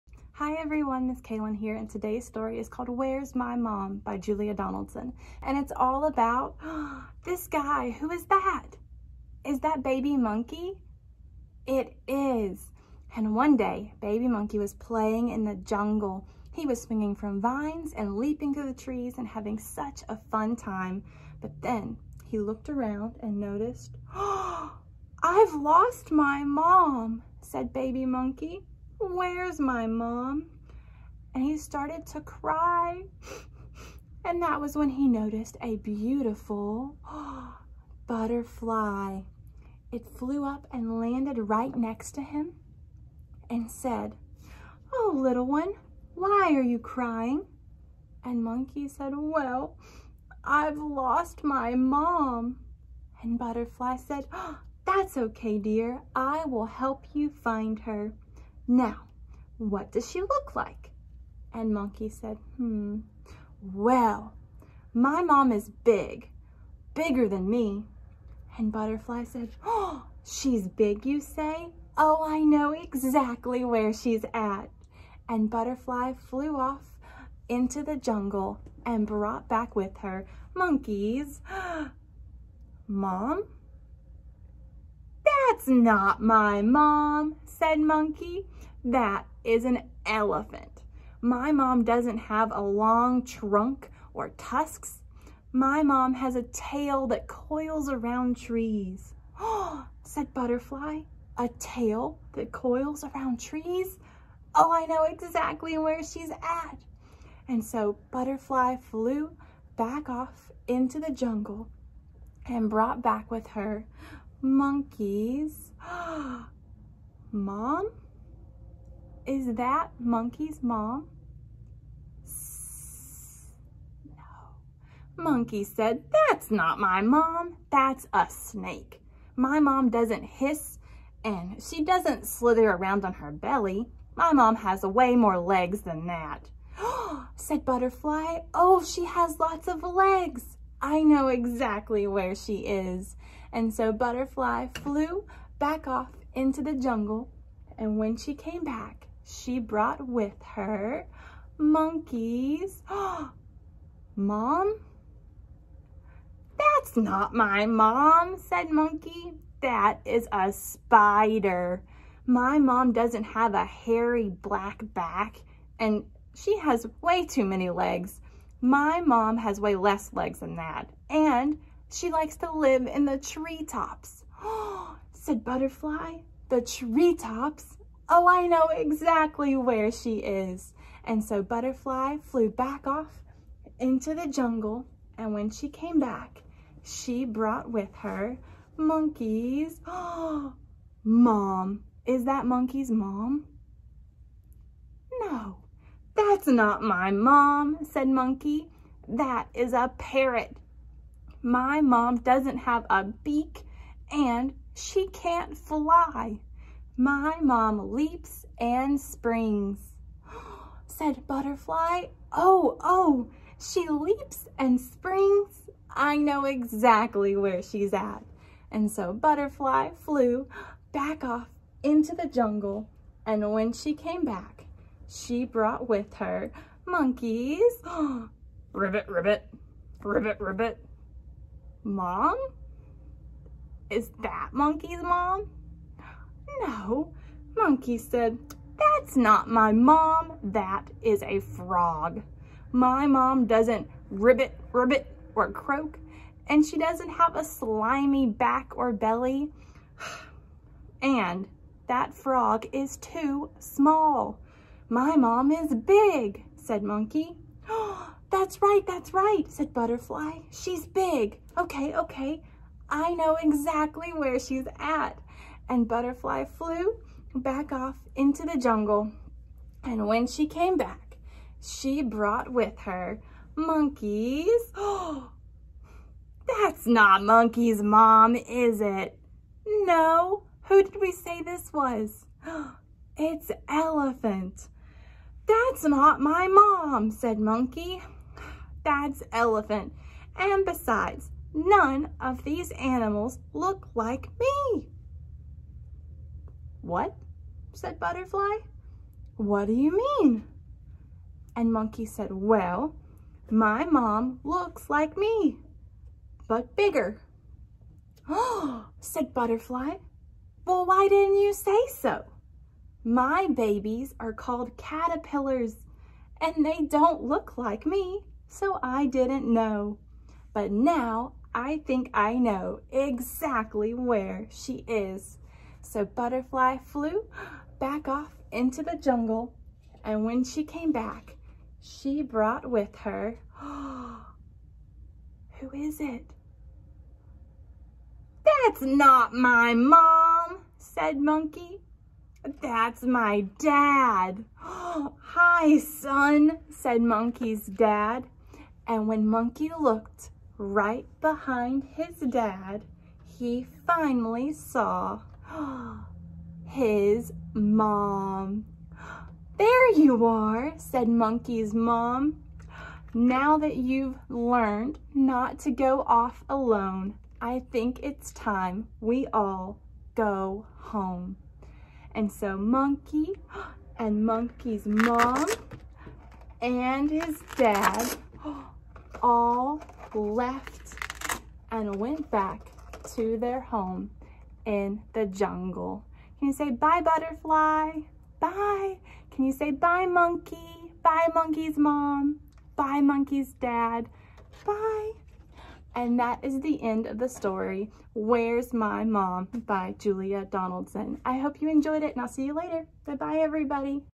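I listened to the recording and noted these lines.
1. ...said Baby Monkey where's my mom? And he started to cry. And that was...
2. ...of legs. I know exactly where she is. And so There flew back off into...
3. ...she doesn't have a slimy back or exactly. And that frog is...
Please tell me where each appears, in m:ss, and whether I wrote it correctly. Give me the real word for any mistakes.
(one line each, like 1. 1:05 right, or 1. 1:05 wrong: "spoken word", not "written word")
1. 0:27 right
2. 2:19 wrong: "Butterfly", not "There"
3. 4:06 wrong: "belly", not "exactly".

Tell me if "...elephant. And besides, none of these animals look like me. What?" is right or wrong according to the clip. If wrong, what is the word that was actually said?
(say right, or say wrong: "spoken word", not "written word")
right.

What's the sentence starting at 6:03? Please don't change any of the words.
Now that you've learned not to go off alone, I think it's time we all go home.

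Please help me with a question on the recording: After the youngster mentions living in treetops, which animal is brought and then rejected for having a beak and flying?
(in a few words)
Parrot.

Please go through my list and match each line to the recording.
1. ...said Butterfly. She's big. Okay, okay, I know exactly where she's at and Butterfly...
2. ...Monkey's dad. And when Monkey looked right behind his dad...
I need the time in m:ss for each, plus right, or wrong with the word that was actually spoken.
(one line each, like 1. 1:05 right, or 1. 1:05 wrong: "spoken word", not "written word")
1. 4:19 right
2. 5:47 right.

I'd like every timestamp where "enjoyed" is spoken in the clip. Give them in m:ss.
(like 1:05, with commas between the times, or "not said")
6:41.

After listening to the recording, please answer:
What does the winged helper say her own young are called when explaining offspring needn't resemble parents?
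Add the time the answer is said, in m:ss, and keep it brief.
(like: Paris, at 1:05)
Caterpillars, at 5:14.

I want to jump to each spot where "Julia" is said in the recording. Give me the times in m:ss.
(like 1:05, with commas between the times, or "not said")
0:04, 6:39.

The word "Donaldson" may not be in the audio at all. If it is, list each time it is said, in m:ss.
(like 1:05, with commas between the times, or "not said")
0:04, 6:40.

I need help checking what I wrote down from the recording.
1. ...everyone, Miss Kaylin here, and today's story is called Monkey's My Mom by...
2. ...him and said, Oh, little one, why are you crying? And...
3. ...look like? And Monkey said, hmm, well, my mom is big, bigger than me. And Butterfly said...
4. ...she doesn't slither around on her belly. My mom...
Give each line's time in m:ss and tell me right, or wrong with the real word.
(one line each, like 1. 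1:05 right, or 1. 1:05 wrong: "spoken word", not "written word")
1. 0:00 wrong: "Where", not "Monkey"
2. 0:42 right
3. 1:00 right
4. 2:11 right.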